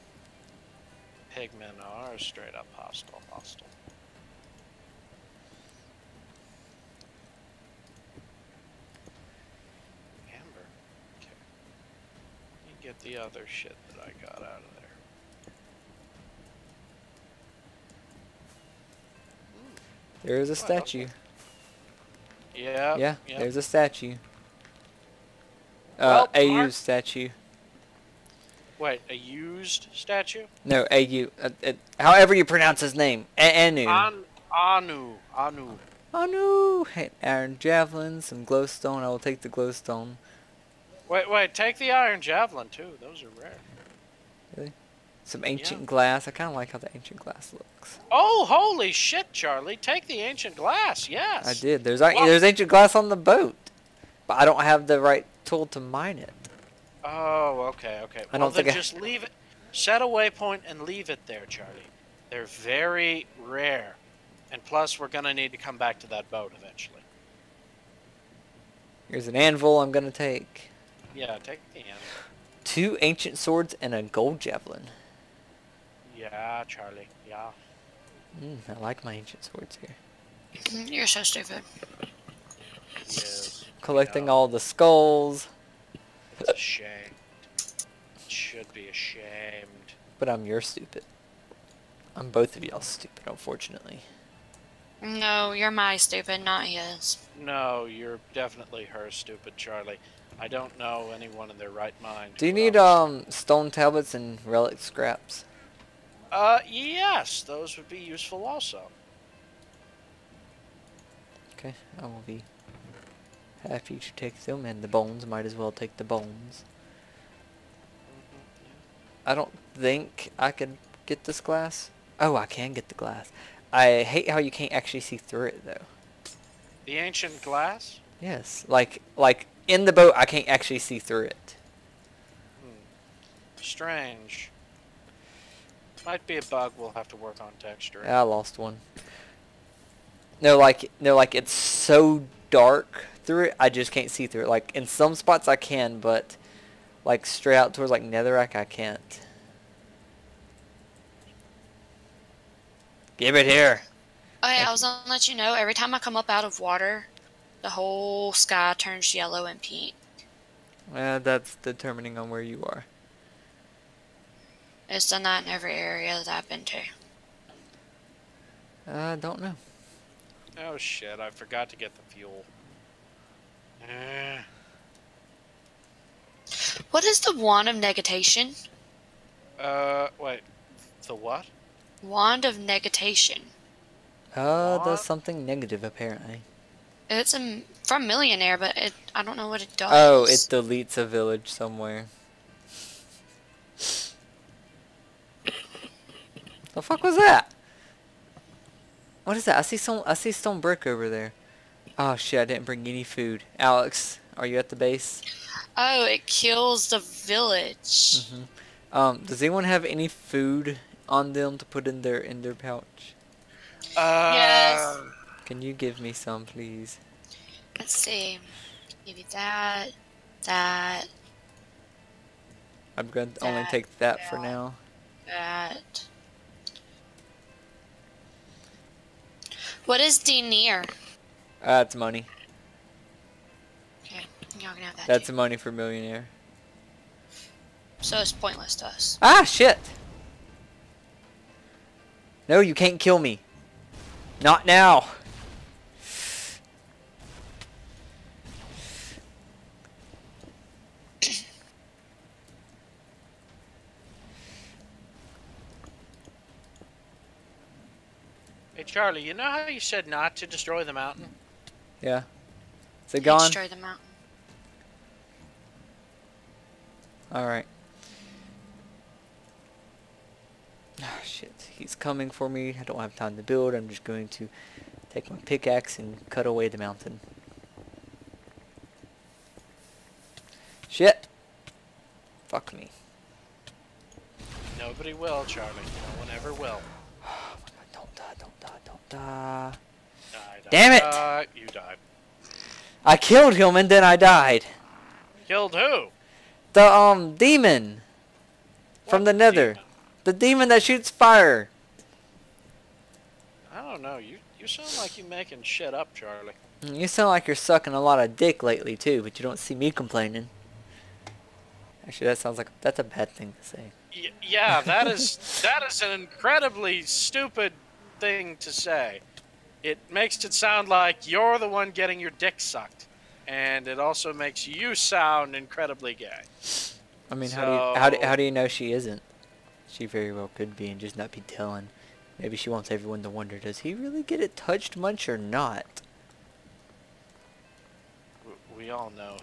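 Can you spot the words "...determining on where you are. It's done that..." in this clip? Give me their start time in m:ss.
2:41.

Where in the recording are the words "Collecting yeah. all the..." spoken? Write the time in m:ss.
1:23.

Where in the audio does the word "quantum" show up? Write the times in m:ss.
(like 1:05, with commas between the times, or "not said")
not said.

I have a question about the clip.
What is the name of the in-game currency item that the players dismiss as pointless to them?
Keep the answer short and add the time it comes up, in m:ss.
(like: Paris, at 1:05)
Denier, at 3:50.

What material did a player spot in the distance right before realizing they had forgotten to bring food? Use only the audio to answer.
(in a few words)
Stone brick.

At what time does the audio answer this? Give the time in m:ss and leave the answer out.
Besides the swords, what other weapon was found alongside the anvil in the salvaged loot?
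1:14.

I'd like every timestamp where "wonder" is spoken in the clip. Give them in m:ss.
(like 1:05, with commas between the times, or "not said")
5:33.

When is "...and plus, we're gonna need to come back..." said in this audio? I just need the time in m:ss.
1:04.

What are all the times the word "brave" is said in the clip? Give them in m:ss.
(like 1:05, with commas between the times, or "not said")
not said.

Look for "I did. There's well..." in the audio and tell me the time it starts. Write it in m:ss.
0:51.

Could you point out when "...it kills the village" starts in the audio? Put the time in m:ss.
3:26.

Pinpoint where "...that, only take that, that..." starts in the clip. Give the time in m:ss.
3:43.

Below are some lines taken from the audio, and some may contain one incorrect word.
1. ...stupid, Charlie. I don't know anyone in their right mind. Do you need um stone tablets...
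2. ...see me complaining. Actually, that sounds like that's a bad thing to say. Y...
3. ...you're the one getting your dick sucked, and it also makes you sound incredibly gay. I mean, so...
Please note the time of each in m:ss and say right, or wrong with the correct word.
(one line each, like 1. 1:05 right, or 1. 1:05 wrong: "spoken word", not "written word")
1. 1:39 right
2. 5:09 right
3. 5:21 right.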